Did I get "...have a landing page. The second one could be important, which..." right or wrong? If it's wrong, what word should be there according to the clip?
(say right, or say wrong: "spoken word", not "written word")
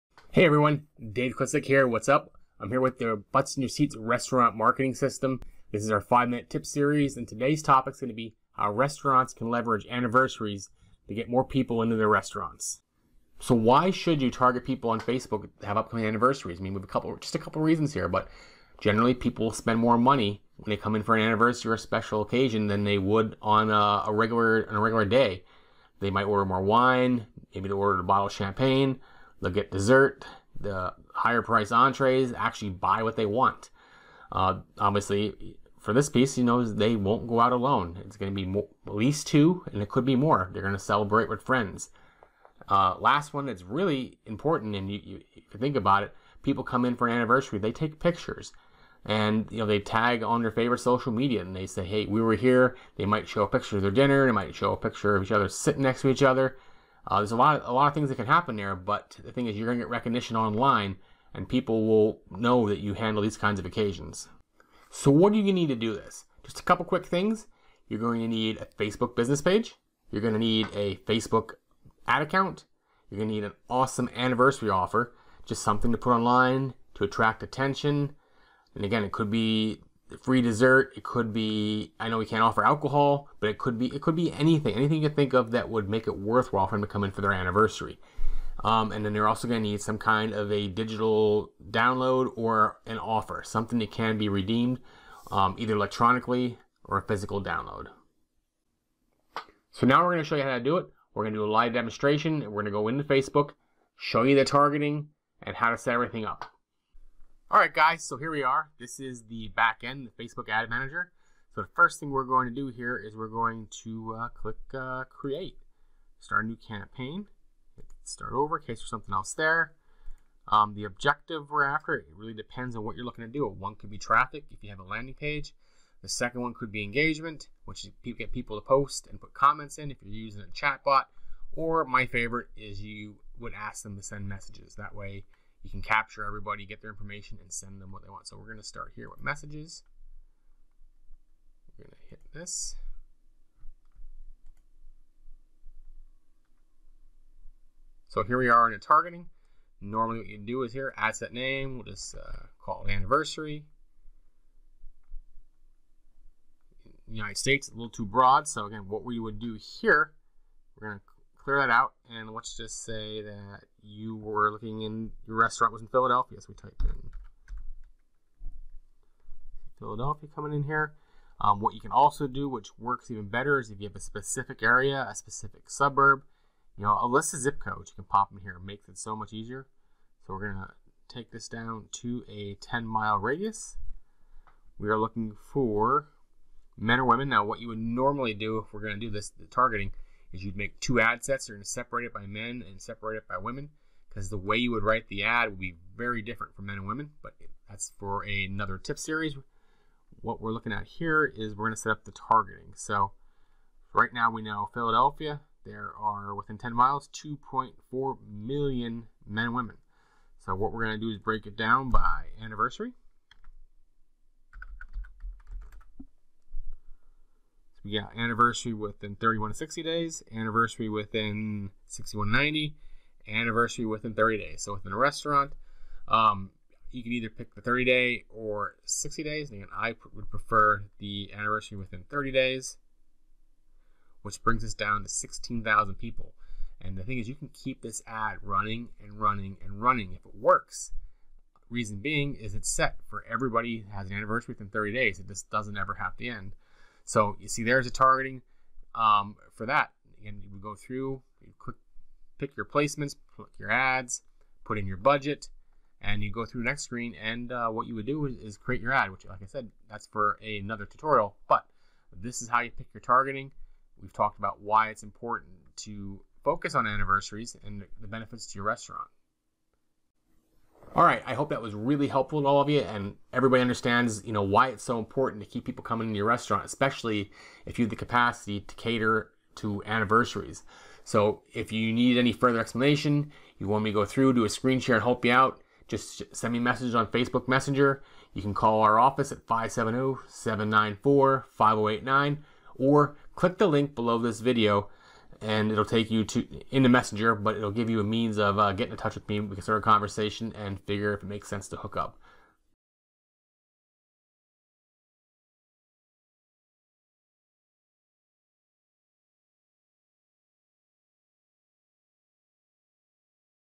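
wrong: "engagement", not "important".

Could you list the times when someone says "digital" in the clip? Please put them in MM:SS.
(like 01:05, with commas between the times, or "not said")
01:30.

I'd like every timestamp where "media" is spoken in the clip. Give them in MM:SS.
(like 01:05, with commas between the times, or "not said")
00:51.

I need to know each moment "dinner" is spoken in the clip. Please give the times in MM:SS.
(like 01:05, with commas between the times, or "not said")
00:53.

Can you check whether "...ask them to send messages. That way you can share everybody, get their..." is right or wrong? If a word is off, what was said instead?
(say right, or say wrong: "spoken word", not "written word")
wrong: "capture", not "share".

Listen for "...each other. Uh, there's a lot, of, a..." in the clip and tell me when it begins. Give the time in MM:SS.
00:56.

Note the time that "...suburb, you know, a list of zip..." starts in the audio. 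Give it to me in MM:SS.
02:55.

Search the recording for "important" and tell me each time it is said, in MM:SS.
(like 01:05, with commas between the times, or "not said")
00:44, 04:25, 04:34.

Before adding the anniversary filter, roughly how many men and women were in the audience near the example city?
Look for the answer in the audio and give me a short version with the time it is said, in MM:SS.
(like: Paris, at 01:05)
2.4 million, at 03:27.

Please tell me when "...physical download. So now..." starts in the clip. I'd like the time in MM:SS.
01:37.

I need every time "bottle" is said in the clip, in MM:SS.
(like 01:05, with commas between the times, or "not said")
00:28.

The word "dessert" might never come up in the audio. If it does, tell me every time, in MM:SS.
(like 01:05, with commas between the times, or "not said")
00:29, 01:20.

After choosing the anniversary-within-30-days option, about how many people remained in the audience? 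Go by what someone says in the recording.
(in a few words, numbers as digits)
16,000.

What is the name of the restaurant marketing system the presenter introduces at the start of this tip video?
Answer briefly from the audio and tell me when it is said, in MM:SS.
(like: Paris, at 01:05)
Butts in Your Seats, at 00:03.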